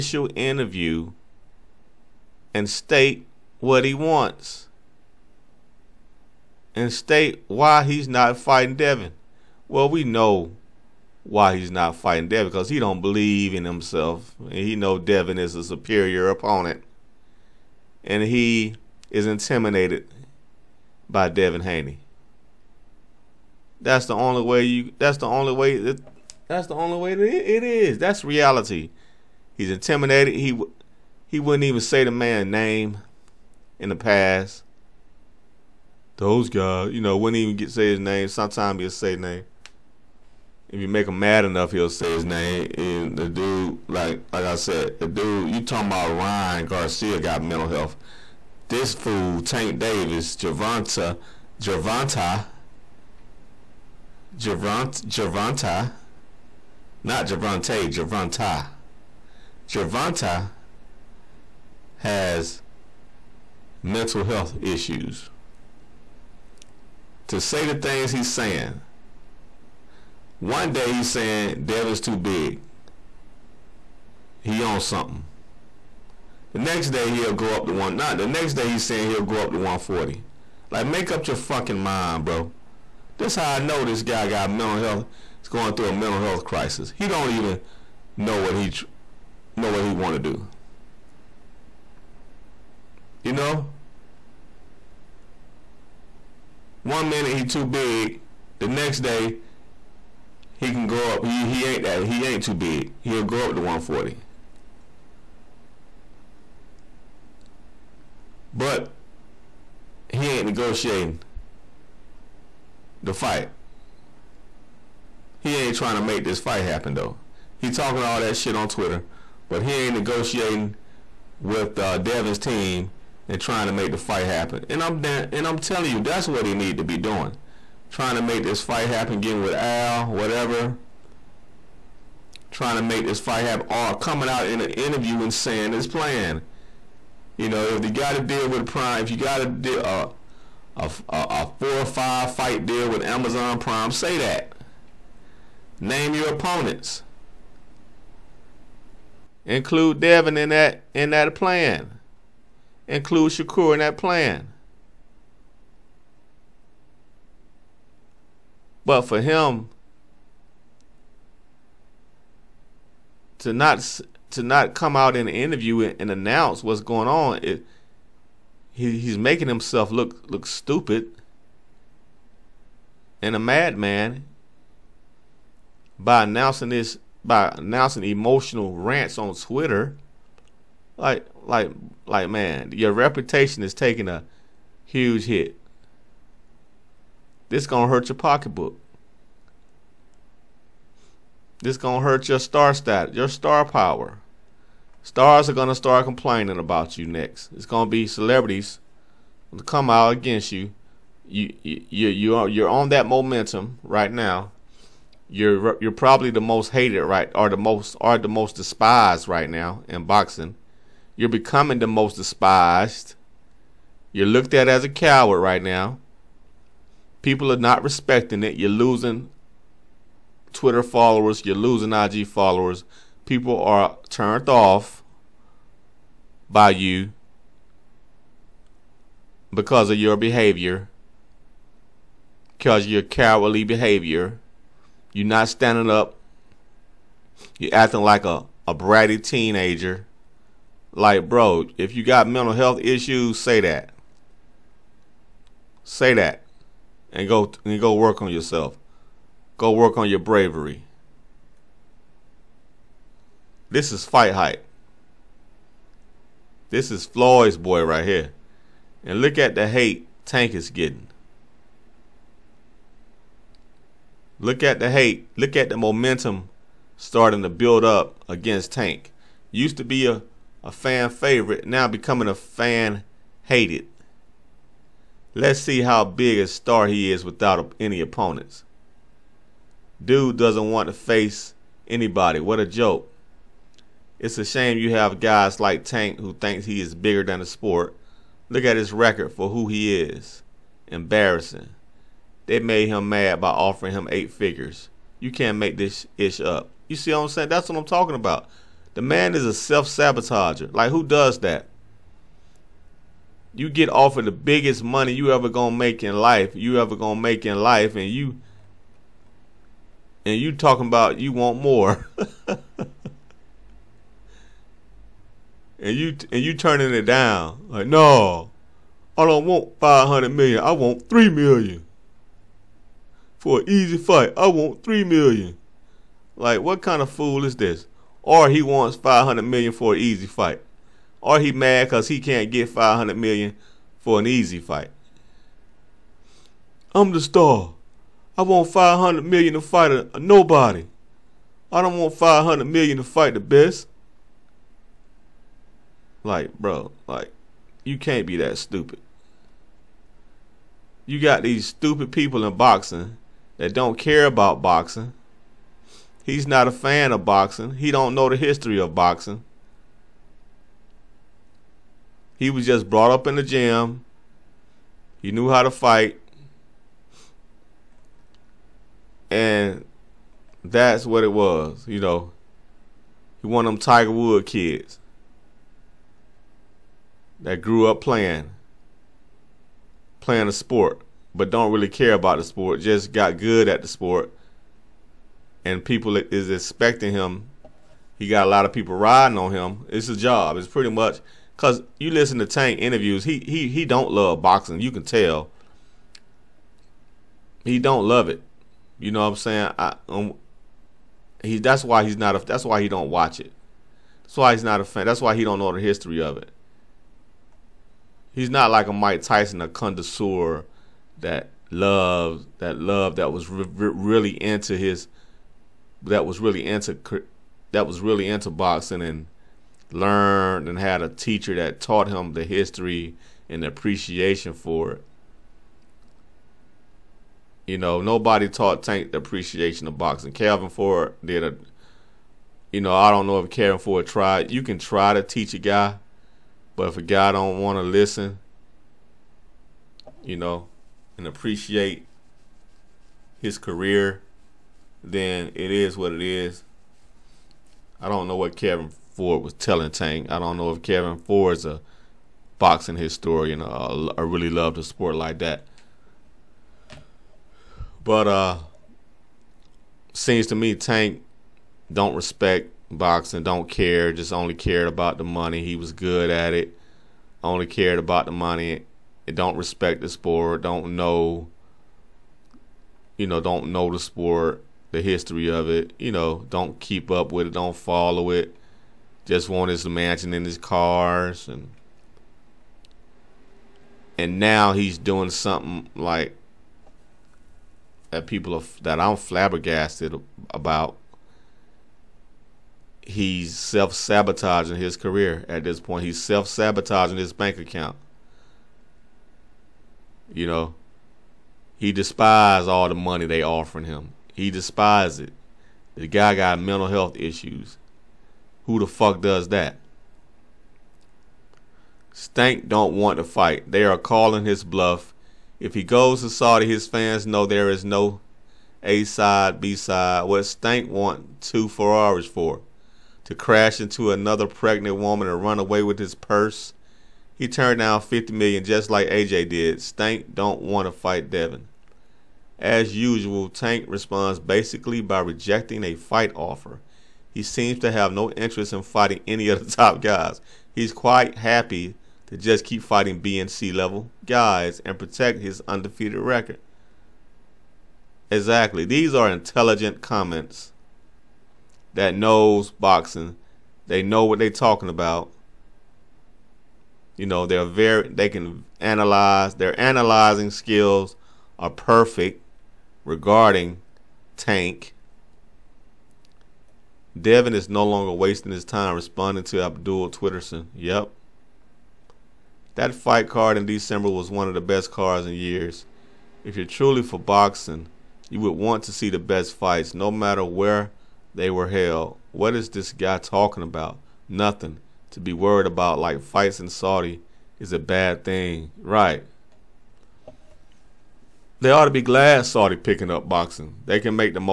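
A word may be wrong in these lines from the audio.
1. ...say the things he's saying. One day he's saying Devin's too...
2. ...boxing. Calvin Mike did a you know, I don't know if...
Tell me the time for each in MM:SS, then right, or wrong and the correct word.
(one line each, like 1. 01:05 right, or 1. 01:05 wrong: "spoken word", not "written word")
1. 01:07 right
2. 07:09 wrong: "Ford", not "Mike".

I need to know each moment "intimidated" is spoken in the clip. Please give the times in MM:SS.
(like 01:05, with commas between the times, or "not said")
00:19, 00:29.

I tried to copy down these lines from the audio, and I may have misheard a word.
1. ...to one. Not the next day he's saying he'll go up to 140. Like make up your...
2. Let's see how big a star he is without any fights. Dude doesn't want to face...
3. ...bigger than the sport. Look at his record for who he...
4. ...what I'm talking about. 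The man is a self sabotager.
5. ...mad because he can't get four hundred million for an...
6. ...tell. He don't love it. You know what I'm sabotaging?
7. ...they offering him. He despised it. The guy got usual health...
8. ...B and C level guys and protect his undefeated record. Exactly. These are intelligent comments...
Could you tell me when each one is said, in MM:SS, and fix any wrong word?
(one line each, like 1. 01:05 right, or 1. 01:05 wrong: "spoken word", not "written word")
1. 01:17 right
2. 04:35 wrong: "opponents", not "fights"
3. 04:46 right
4. 04:57 right
5. 05:31 wrong: "five", not "four"
6. 06:35 wrong: "saying", not "sabotaging"
7. 08:23 wrong: "mental", not "usual"
8. 09:03 right.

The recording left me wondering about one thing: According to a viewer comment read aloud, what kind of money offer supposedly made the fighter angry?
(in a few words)
eight figures.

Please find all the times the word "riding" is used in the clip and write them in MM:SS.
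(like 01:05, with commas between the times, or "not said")
06:28.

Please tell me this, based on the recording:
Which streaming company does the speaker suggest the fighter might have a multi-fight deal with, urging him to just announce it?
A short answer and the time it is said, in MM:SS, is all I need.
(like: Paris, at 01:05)
Amazon Prime, at 02:23.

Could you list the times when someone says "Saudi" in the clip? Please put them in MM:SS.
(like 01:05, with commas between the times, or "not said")
08:36, 09:46, 09:52.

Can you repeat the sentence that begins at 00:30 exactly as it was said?
He he wouldn't even say the man's name in the past.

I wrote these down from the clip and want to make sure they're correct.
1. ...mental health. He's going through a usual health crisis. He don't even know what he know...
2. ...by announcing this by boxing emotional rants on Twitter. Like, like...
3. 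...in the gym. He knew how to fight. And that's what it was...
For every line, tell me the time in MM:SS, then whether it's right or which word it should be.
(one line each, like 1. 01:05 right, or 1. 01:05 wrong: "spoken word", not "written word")
1. 01:24 wrong: "mental", not "usual"
2. 02:55 wrong: "announcing", not "boxing"
3. 06:03 right.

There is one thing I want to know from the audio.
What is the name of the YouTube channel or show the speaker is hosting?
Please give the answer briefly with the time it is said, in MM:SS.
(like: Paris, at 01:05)
Fight Hype, at 04:14.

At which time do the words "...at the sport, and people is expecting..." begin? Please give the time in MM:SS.
06:23.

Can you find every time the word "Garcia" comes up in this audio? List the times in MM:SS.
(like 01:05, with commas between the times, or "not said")
00:46.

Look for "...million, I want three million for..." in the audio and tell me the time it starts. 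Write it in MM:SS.
05:20.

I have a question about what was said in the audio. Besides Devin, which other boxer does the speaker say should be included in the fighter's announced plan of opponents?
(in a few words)
Shakur.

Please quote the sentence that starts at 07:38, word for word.
But uh, seems to me Tank don't respect boxing, don't care, just only cared about the money.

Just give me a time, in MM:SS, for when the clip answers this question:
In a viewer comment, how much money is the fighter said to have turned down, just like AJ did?
08:48.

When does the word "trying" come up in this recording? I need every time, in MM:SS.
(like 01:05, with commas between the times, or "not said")
01:55, 02:03, 02:07, 02:12.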